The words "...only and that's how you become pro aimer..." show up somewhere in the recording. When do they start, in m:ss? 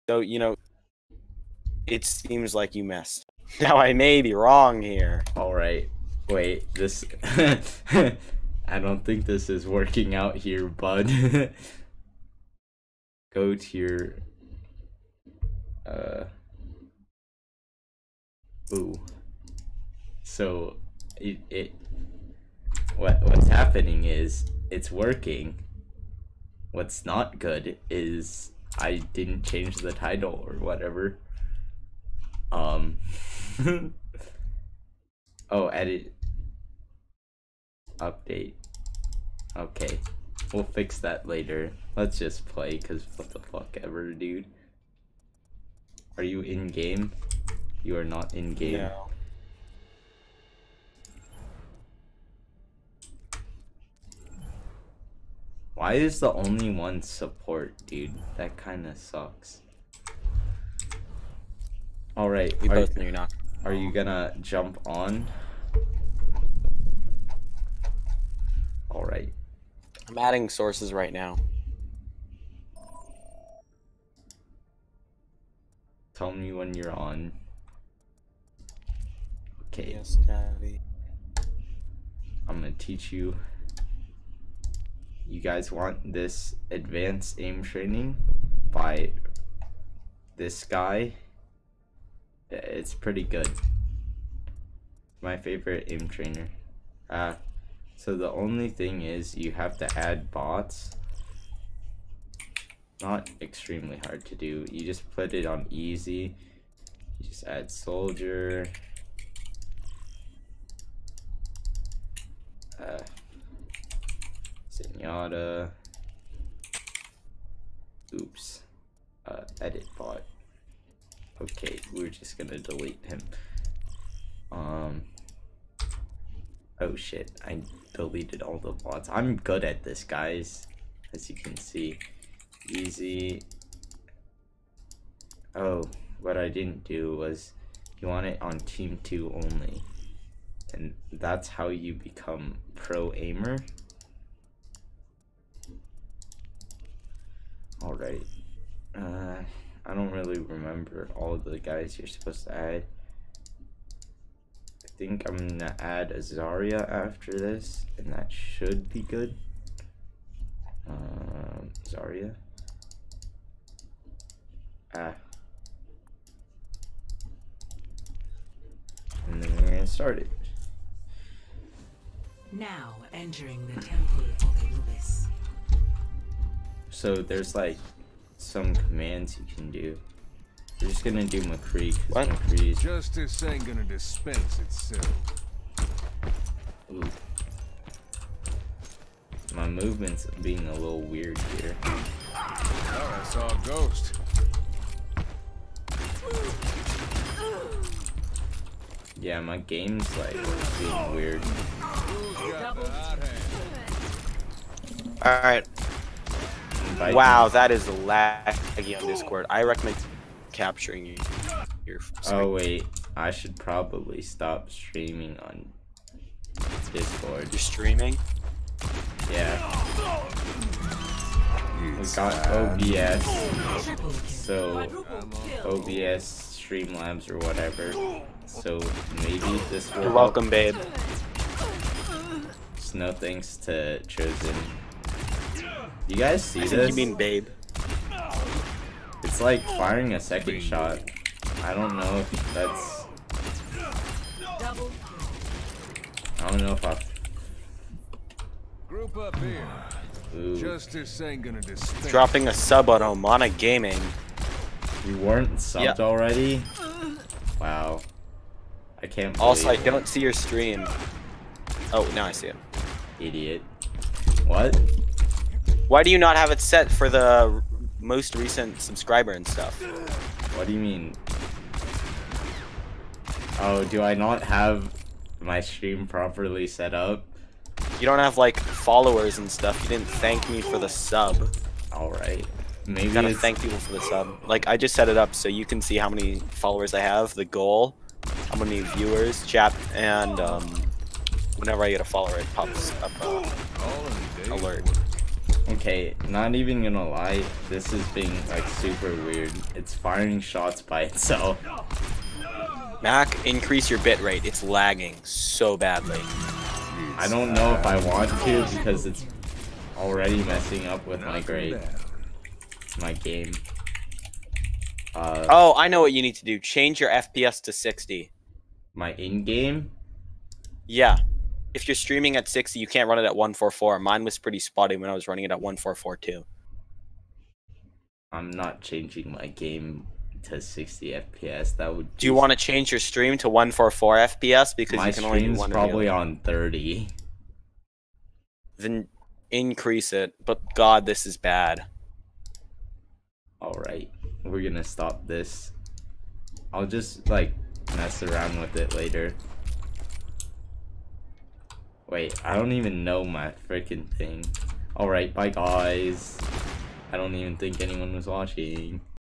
2:19.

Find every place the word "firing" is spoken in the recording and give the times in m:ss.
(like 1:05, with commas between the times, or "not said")
3:59, 4:59.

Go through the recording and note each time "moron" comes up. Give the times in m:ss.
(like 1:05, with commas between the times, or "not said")
not said.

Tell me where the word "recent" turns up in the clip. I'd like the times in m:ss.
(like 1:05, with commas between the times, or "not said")
4:28.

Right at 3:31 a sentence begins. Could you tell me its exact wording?
Your oh wait, I should probably stop streaming on Discord.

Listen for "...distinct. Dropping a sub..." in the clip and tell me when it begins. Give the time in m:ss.
4:11.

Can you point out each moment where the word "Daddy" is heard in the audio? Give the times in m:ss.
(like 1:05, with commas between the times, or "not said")
1:20.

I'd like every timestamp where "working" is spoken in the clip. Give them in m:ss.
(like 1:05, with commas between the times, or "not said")
0:09, 0:24.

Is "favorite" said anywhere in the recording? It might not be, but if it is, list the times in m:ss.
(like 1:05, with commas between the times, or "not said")
1:35.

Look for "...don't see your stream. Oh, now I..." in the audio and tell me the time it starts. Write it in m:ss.
4:19.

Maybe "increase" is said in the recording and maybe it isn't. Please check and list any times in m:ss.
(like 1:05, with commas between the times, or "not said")
5:03, 5:39.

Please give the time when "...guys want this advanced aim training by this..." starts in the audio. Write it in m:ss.
1:25.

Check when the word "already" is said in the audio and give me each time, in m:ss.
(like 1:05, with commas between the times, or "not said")
4:16, 5:09.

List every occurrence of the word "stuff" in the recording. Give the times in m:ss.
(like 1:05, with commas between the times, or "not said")
4:29, 4:39.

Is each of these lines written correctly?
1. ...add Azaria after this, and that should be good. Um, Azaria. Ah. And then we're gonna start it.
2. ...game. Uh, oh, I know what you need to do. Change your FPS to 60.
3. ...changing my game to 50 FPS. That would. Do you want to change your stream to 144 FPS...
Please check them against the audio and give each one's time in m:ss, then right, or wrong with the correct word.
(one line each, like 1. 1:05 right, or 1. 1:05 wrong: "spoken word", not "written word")
1. 2:35 right
2. 5:13 right
3. 5:28 wrong: "60", not "50".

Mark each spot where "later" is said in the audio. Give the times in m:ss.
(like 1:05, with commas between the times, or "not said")
0:41, 5:48.